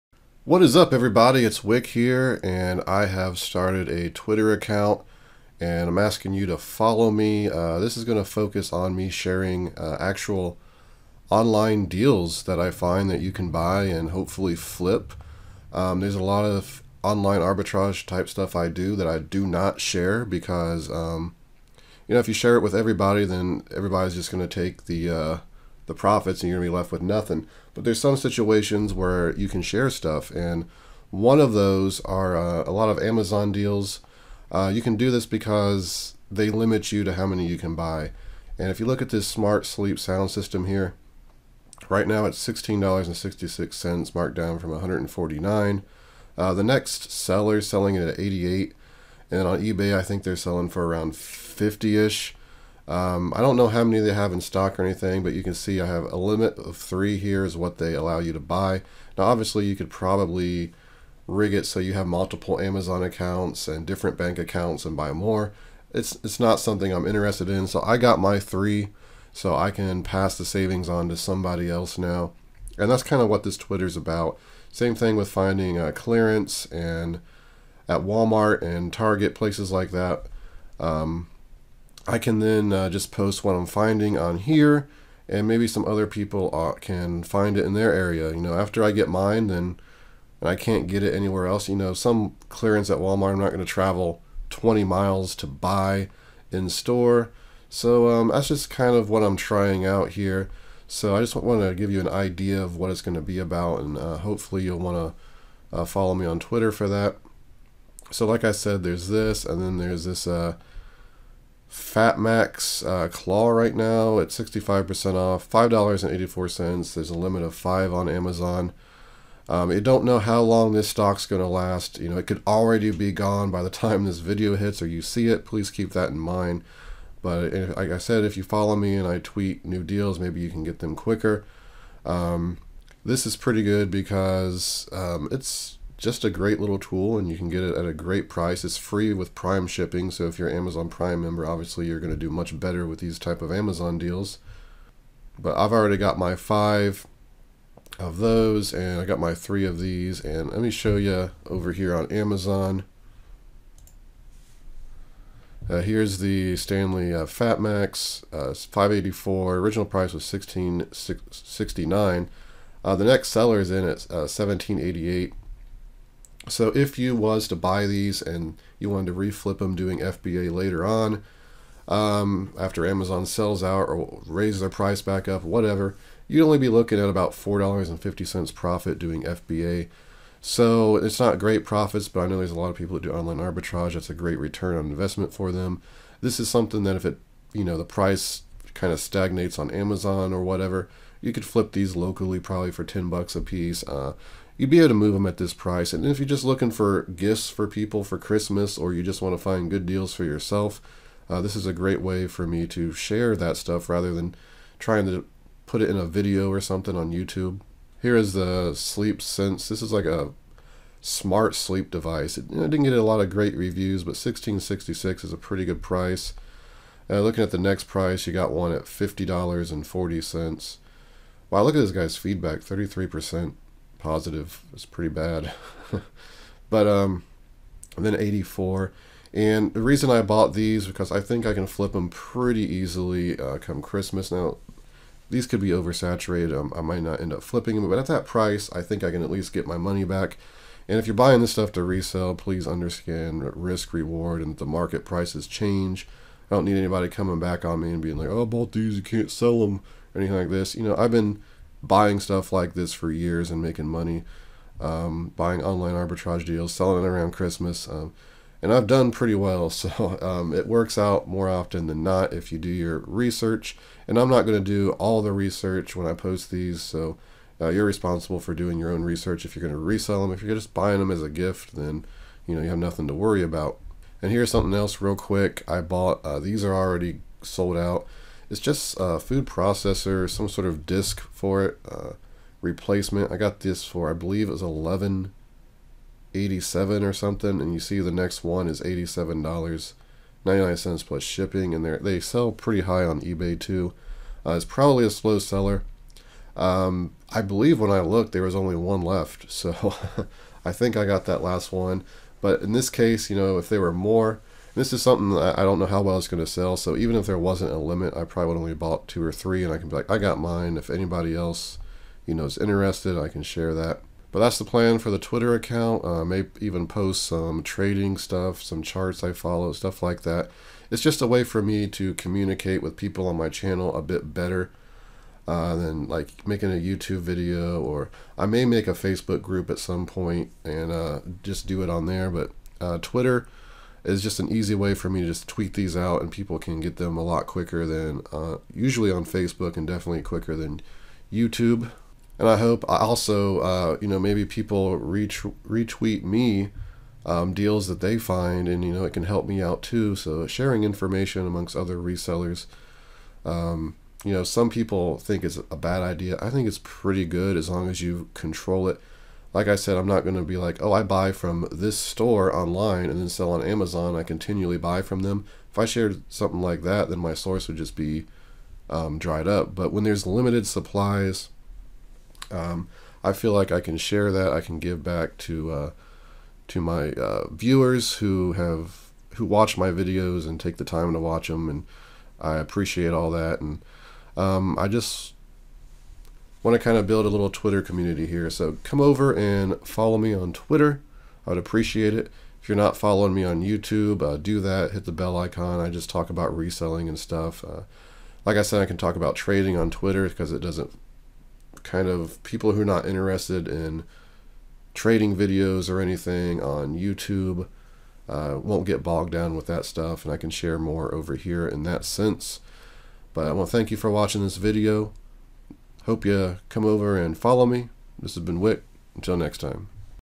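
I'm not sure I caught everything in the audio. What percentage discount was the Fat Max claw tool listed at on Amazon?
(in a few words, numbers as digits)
65%.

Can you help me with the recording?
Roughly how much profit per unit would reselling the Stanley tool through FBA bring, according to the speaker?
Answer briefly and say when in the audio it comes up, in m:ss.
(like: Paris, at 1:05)
$4.50, at 2:57.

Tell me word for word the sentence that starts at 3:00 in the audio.
So it's not great profits, but I know there's a lot of people that do online arbitrage.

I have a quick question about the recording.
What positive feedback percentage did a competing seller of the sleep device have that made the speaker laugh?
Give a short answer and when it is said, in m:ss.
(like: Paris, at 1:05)
33%, at 3:42.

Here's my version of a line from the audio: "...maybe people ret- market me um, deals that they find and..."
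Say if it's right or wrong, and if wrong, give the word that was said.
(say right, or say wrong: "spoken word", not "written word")
wrong: "retweet", not "market".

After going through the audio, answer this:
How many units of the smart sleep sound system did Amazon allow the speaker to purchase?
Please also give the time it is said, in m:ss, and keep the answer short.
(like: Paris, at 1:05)
3, at 0:56.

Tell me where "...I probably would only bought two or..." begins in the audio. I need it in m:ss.
5:08.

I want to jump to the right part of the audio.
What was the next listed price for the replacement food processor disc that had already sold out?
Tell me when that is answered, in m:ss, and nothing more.
4:48.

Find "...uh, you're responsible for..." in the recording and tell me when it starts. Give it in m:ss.
4:27.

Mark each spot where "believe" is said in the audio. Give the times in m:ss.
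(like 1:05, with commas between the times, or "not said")
4:44, 4:57.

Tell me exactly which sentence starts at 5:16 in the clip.
Uh, I may even post some trading stuff, some charts I follow, stuff like that.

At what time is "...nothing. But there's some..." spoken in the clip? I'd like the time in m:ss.
0:27.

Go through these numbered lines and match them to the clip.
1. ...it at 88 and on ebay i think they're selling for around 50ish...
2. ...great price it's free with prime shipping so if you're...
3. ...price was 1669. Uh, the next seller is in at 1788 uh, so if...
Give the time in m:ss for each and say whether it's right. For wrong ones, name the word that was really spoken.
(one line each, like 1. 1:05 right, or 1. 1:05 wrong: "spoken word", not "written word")
1. 0:47 right
2. 2:17 right
3. 2:39 right.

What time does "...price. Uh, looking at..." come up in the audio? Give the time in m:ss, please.
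3:35.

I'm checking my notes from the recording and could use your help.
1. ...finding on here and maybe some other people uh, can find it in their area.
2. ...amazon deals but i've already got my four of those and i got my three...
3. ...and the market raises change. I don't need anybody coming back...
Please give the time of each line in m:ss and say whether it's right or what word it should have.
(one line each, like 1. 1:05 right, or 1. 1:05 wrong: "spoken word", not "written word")
1. 1:23 right
2. 2:23 wrong: "five", not "four"
3. 4:04 wrong: "prices", not "raises".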